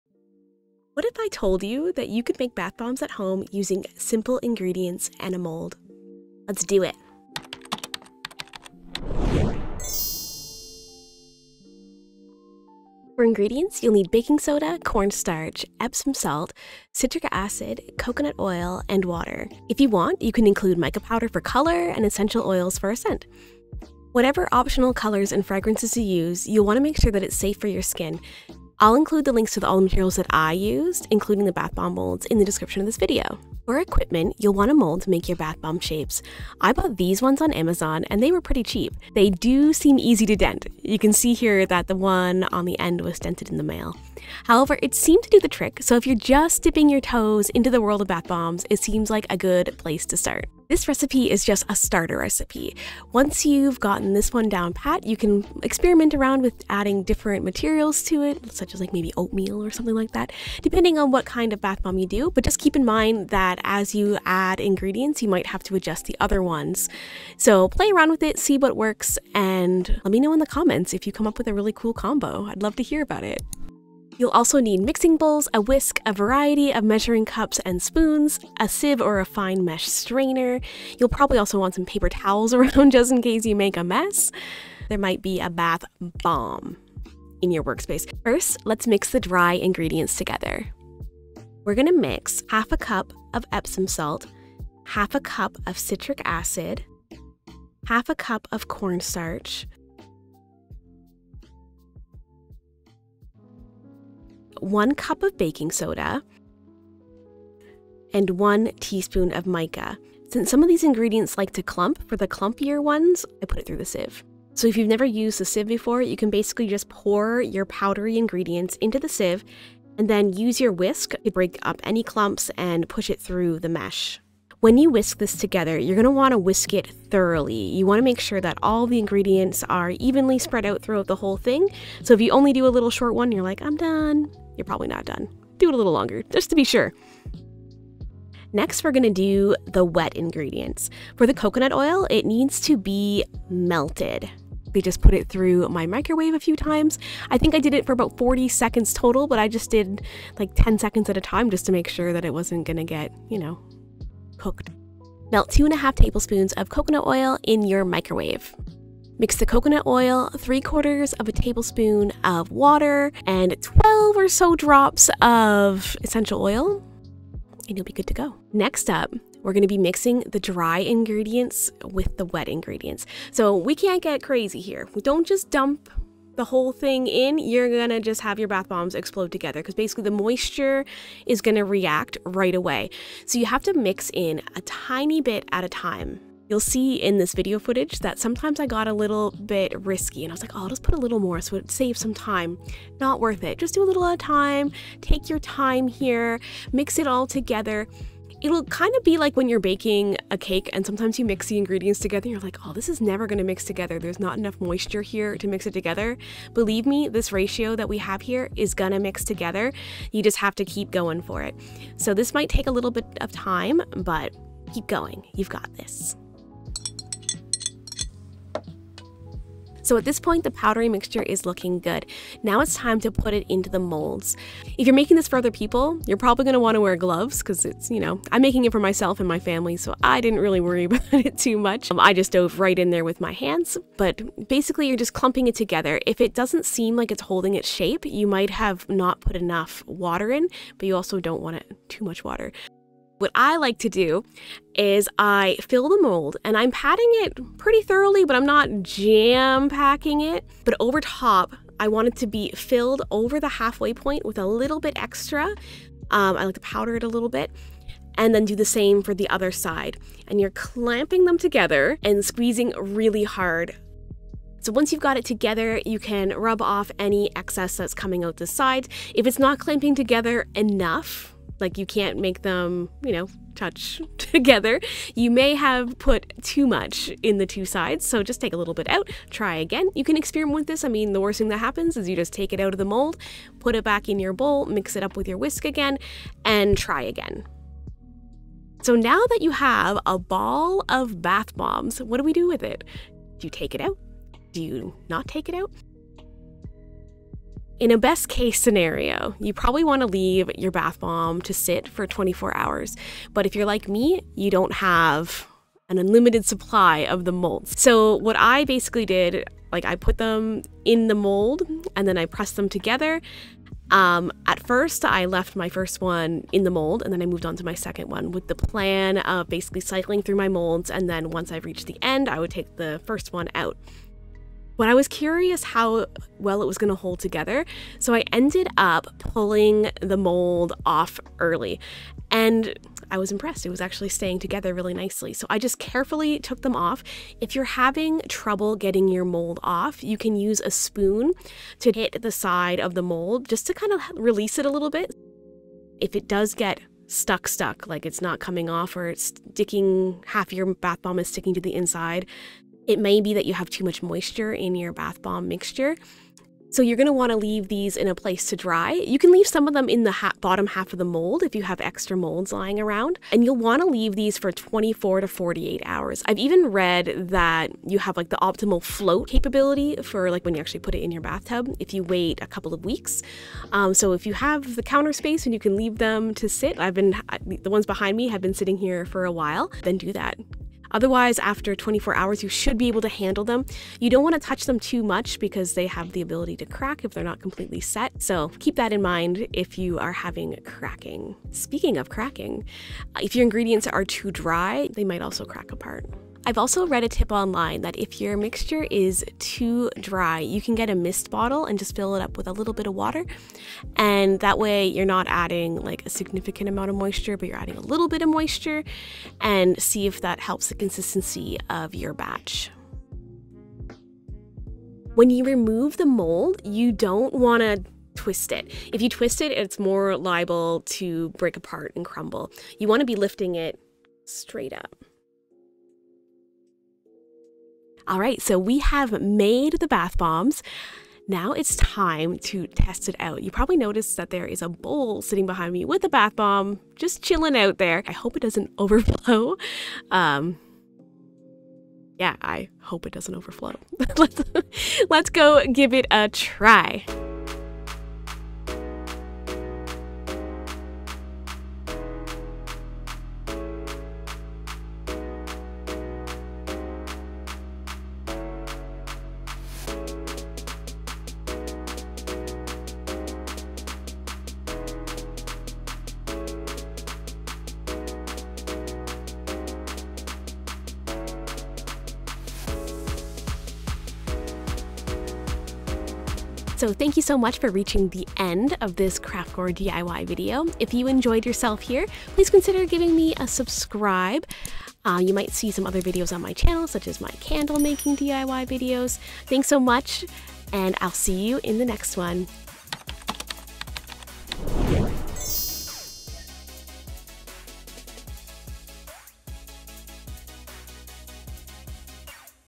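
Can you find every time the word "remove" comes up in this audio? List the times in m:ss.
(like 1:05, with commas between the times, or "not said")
6:55.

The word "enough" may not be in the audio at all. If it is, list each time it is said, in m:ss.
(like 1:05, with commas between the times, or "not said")
3:24, 3:59, 4:30.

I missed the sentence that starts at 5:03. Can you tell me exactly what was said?
But if you're like me, you don't have an unlimited supply of the molds.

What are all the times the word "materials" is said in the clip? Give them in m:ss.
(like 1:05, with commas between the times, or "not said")
0:29, 0:57.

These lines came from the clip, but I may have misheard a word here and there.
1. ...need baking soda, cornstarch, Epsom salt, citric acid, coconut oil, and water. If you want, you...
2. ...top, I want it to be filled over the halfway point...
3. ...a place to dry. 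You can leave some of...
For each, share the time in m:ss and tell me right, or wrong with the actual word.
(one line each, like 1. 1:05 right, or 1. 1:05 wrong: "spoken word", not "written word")
1. 0:13 right
2. 4:11 right
3. 5:58 right.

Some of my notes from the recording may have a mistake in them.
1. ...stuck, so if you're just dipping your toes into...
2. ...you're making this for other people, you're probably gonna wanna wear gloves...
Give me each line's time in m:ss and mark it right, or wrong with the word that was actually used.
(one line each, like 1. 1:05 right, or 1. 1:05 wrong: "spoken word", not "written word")
1. 0:45 wrong: "trick", not "stuck"
2. 3:44 right.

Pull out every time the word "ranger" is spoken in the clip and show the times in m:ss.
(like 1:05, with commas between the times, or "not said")
not said.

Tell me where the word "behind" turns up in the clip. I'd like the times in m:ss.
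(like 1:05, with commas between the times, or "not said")
6:17, 7:15.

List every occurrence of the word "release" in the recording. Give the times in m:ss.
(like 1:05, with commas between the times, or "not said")
5:44.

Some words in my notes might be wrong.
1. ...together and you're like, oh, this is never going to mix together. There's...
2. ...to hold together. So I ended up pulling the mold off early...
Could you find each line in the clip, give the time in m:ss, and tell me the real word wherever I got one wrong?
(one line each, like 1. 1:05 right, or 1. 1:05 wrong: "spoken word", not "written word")
1. 3:21 right
2. 5:26 right.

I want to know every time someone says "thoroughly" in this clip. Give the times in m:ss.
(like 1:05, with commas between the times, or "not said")
2:07, 4:07.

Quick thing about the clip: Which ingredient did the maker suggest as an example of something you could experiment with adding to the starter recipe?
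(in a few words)
oatmeal.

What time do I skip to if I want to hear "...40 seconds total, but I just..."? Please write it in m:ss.
2:28.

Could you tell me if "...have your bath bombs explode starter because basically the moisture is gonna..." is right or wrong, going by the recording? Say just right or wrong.
wrong.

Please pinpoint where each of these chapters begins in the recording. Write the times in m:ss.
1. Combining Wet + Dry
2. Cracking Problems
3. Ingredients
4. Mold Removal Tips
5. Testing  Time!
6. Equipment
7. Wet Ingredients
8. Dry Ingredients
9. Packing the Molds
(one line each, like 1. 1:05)
1. 2:49
2. 6:23
3. 0:13
4. 6:54
5. 7:28
6. 0:33
7. 2:20
8. 1:30
9. 3:42.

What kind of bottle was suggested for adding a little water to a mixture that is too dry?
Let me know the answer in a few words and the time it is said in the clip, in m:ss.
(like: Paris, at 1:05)
mist bottle, at 6:40.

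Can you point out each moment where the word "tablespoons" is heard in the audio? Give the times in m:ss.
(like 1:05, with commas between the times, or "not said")
2:35, 2:41.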